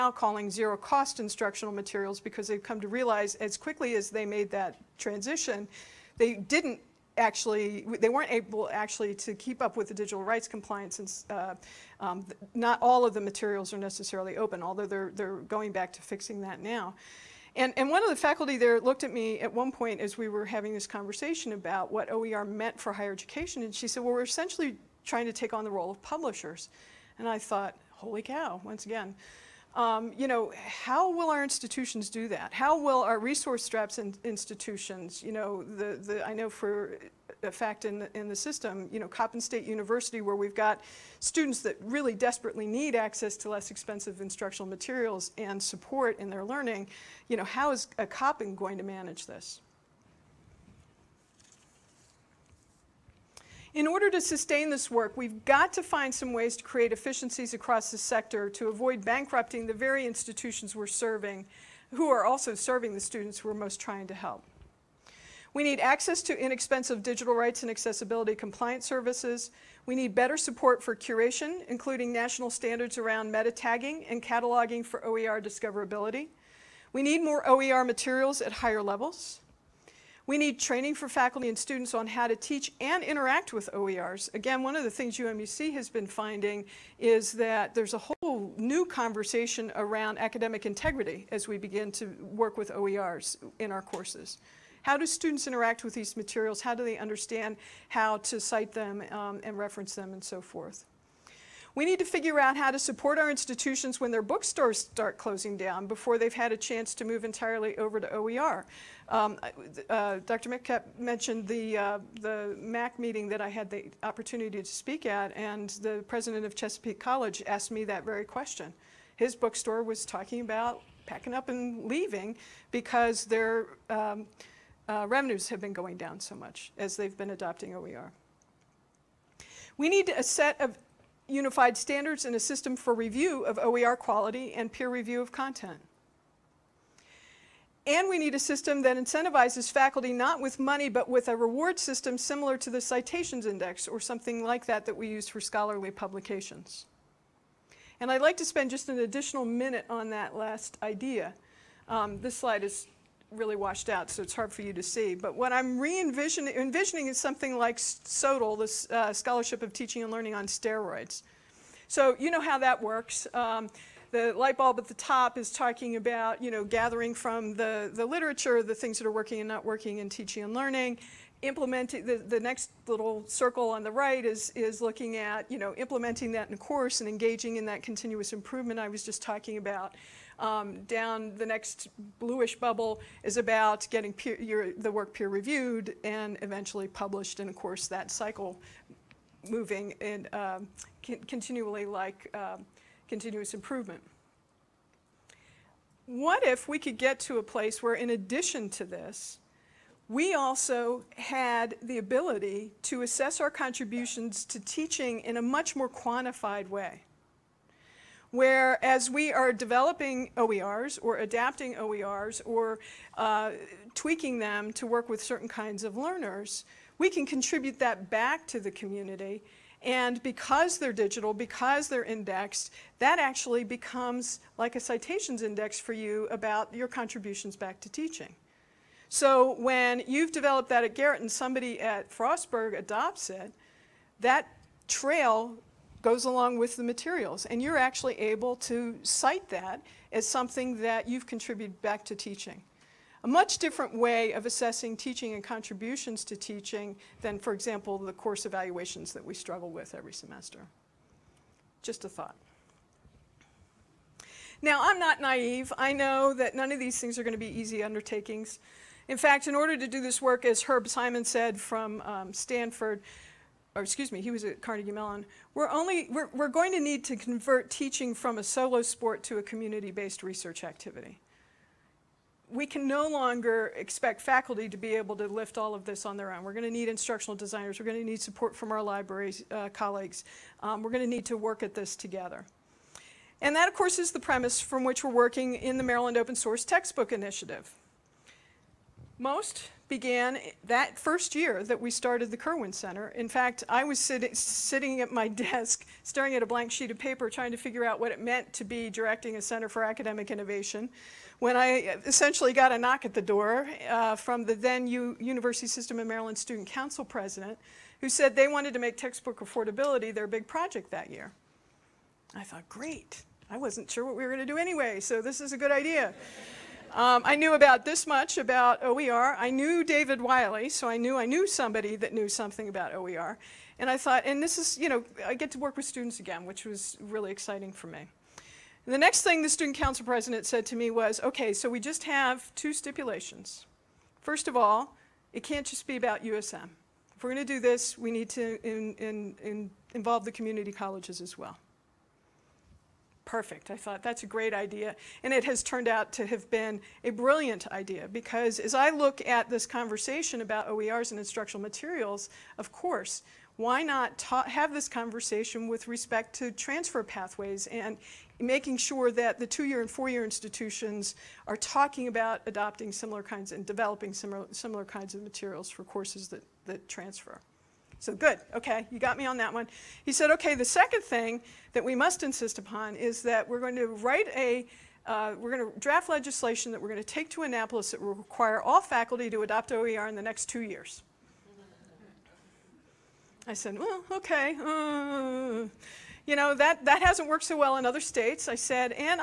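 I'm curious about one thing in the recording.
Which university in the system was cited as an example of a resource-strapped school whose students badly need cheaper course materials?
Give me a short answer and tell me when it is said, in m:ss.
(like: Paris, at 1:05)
Coppin State University, at 0:39.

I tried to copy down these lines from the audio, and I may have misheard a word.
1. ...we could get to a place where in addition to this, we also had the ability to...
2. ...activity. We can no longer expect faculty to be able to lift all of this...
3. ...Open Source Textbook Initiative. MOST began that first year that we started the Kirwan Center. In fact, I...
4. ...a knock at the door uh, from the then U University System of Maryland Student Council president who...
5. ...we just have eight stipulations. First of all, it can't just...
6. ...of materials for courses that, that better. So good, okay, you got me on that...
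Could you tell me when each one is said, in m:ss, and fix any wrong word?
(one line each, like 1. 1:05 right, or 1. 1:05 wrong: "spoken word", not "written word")
1. 3:16 right
2. 4:30 right
3. 4:46 right
4. 5:02 right
5. 5:31 wrong: "two", not "eight"
6. 6:05 wrong: "transfer", not "better".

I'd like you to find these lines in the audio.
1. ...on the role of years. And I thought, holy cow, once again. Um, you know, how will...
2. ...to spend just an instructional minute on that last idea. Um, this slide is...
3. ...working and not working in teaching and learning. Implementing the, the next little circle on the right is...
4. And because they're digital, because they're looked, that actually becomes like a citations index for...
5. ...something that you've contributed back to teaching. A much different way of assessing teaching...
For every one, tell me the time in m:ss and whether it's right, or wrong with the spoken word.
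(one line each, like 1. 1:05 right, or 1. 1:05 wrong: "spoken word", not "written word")
1. 0:25 wrong: "publishers", not "years"
2. 2:28 wrong: "additional", not "instructional"
3. 2:49 right
4. 3:39 wrong: "indexed", not "looked"
5. 4:00 right.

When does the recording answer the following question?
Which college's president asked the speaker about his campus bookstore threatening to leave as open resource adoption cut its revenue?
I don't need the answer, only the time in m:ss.
1:56.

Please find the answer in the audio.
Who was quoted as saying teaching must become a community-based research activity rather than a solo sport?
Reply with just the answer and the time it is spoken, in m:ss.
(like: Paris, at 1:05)
Herb Simon, at 4:20.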